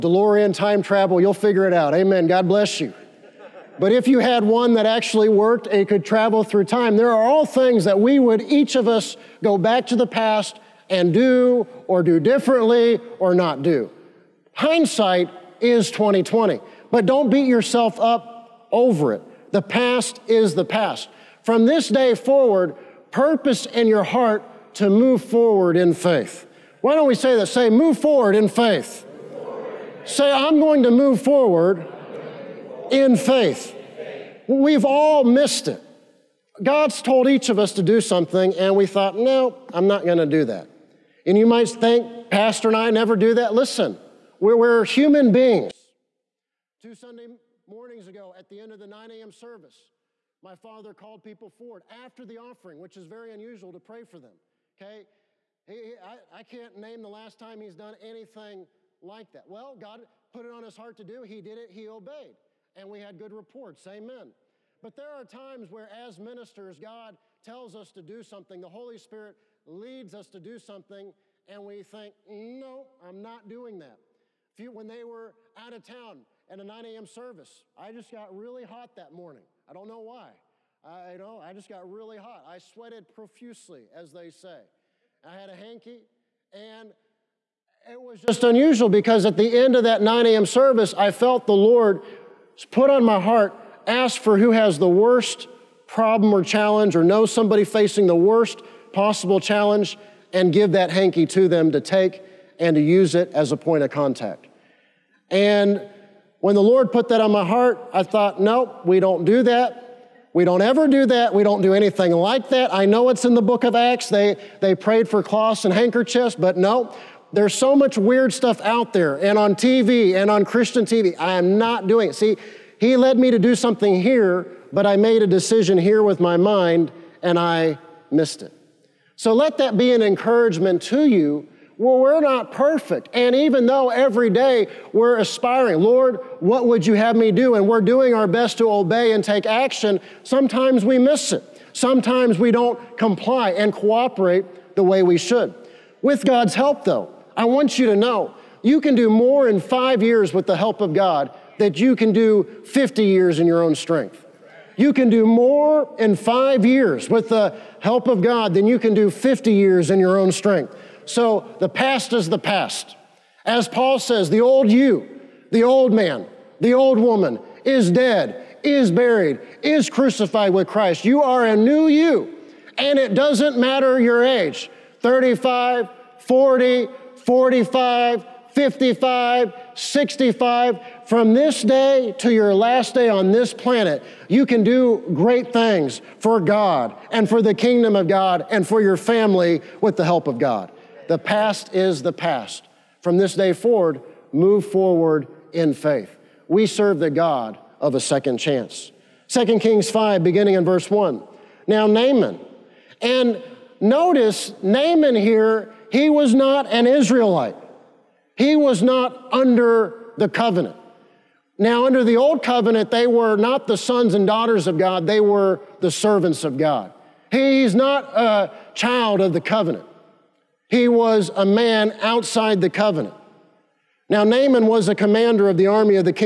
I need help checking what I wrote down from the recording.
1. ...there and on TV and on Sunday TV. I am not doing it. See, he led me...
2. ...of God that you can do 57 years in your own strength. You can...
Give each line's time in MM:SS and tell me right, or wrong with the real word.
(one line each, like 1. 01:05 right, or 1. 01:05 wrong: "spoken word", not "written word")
1. 01:58 wrong: "Christian", not "Sunday"
2. 02:30 wrong: "50", not "57".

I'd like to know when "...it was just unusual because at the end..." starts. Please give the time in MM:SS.
01:27.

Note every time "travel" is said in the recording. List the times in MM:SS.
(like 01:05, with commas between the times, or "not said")
00:00, 00:06.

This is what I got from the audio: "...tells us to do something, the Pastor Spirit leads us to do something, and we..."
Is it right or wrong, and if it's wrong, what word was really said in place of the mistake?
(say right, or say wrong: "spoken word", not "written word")
wrong: "Holy", not "Pastor".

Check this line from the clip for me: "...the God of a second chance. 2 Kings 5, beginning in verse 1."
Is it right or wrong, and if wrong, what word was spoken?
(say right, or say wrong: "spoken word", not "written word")
right.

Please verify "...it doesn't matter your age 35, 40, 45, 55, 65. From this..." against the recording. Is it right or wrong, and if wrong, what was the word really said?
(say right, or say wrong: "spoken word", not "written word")
right.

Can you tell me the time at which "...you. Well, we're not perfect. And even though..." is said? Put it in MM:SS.
02:11.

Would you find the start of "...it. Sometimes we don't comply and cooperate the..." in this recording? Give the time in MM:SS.
02:21.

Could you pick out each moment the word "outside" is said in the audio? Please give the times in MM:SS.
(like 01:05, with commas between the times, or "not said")
03:42.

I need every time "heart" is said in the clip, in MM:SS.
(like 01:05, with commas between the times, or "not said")
00:24, 01:00, 01:33, 01:47.